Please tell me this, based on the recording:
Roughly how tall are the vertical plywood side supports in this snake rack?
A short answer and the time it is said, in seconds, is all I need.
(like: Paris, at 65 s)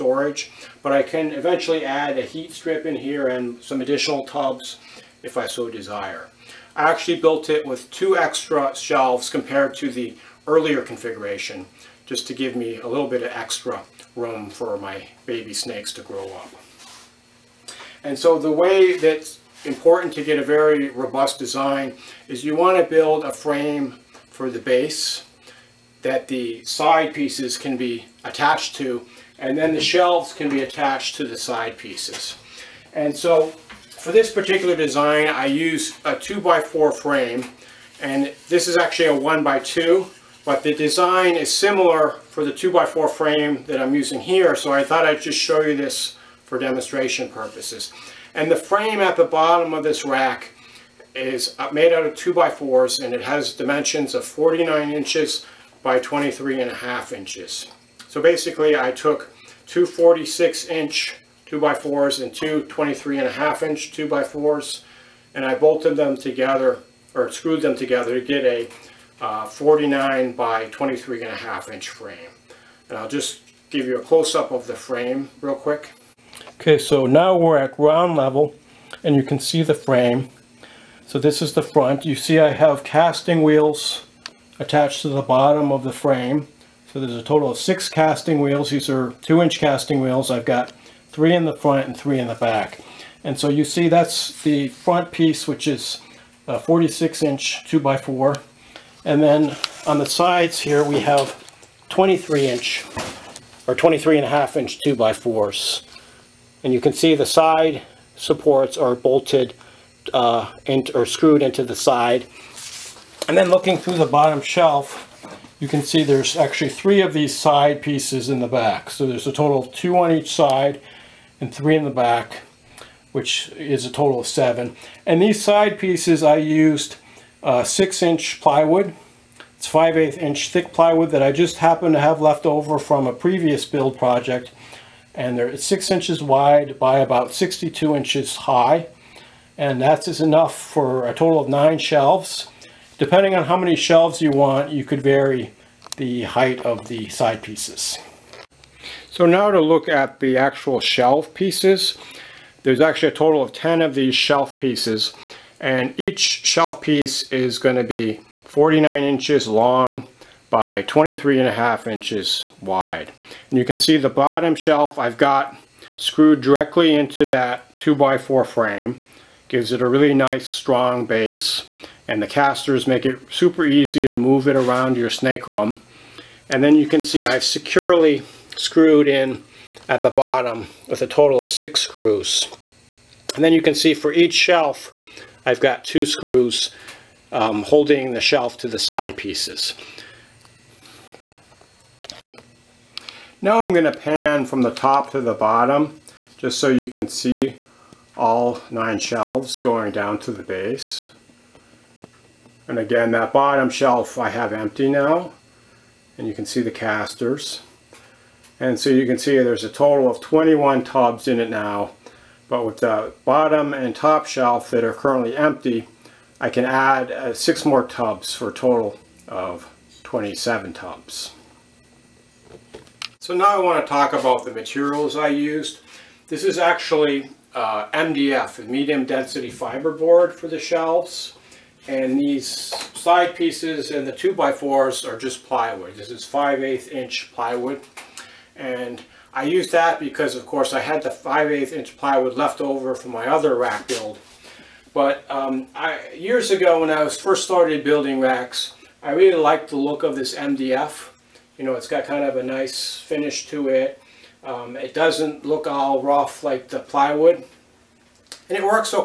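62 inches, at 137 s.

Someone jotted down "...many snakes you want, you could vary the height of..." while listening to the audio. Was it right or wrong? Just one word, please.
wrong.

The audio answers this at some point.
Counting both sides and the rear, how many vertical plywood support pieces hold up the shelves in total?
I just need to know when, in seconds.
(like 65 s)
124 s.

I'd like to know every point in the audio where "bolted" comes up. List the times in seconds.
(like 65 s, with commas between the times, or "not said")
65 s, 108 s.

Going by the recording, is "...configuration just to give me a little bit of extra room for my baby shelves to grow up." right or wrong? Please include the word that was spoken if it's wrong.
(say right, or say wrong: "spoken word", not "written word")
wrong: "snakes", not "shelves".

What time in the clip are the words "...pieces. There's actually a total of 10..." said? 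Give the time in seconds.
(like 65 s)
151 s.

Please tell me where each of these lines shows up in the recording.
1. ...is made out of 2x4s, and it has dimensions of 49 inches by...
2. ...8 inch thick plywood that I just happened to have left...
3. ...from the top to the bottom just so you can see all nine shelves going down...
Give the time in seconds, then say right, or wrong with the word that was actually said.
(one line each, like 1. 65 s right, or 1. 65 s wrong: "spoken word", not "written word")
1. 51 s right
2. 129 s right
3. 194 s right.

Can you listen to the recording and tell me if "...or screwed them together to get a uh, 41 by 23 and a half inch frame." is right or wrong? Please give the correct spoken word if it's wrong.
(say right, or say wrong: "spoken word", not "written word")
wrong: "49", not "41".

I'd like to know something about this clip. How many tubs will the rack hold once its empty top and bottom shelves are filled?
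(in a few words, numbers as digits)
27.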